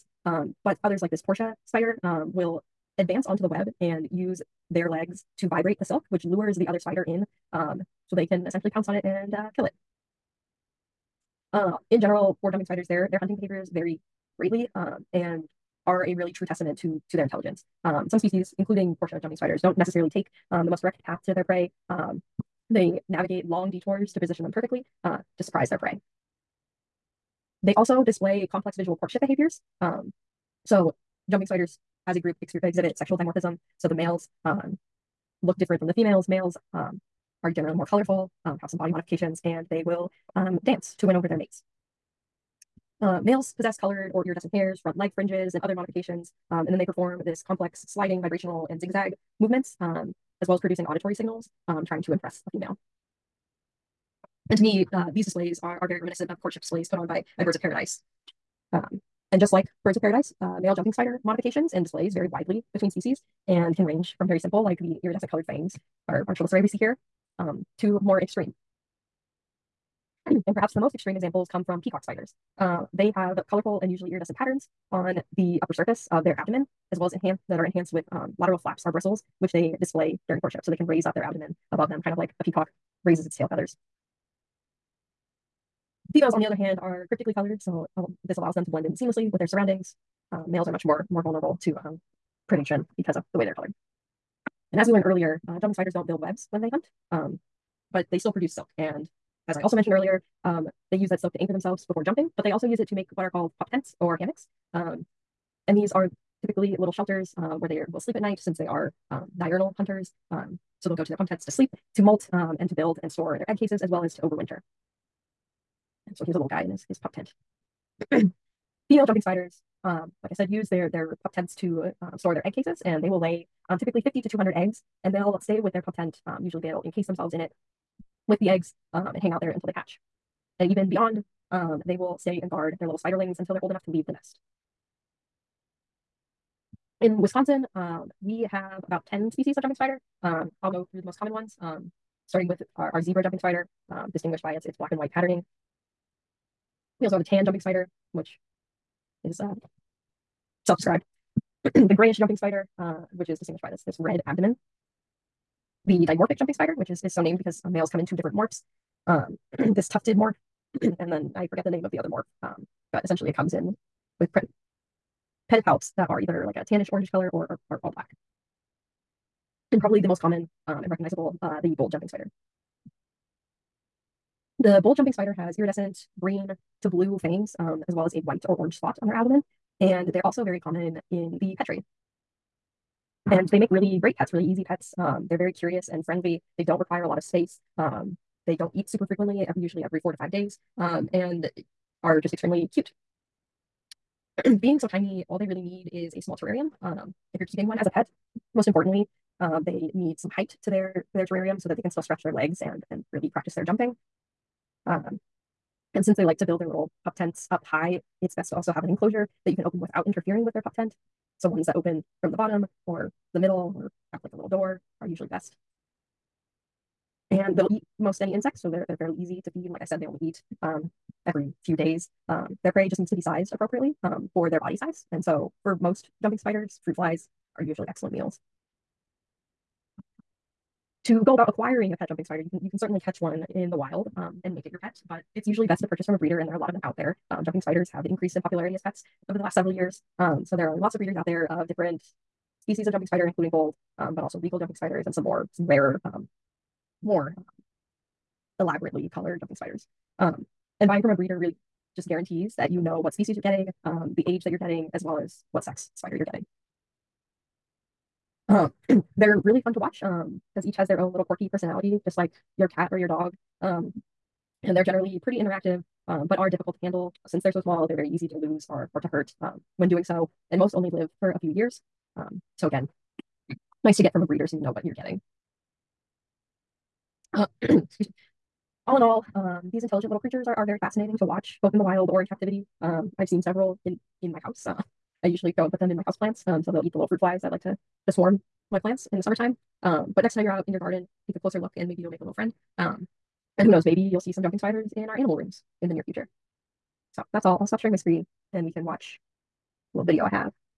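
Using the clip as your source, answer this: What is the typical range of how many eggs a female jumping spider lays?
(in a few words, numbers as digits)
50 to 200.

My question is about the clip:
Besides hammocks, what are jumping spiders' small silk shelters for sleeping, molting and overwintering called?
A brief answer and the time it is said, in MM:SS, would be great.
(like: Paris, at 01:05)
pop tents, at 01:43.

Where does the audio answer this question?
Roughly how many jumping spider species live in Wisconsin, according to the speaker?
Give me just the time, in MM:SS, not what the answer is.
02:19.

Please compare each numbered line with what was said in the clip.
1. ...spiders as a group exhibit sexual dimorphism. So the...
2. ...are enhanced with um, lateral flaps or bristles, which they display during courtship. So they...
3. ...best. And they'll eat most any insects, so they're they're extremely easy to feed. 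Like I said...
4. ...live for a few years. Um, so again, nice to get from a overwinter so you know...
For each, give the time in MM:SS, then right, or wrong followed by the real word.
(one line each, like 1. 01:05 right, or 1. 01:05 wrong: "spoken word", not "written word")
1. 00:31 right
2. 01:17 right
3. 03:35 wrong: "fairly", not "extremely"
4. 04:30 wrong: "breeder", not "overwinter".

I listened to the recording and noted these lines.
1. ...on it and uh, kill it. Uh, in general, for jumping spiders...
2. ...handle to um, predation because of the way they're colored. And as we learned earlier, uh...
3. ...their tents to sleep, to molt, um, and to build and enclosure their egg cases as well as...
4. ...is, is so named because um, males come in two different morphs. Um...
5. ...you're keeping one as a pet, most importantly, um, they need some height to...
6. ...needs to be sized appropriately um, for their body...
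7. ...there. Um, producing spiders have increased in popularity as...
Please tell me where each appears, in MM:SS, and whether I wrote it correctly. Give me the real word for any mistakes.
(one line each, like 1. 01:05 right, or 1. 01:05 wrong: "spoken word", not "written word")
1. 00:08 right
2. 01:31 wrong: "vulnerable", not "handle"
3. 01:51 wrong: "store", not "enclosure"
4. 02:36 right
5. 03:17 right
6. 03:42 right
7. 03:56 wrong: "jumping", not "producing".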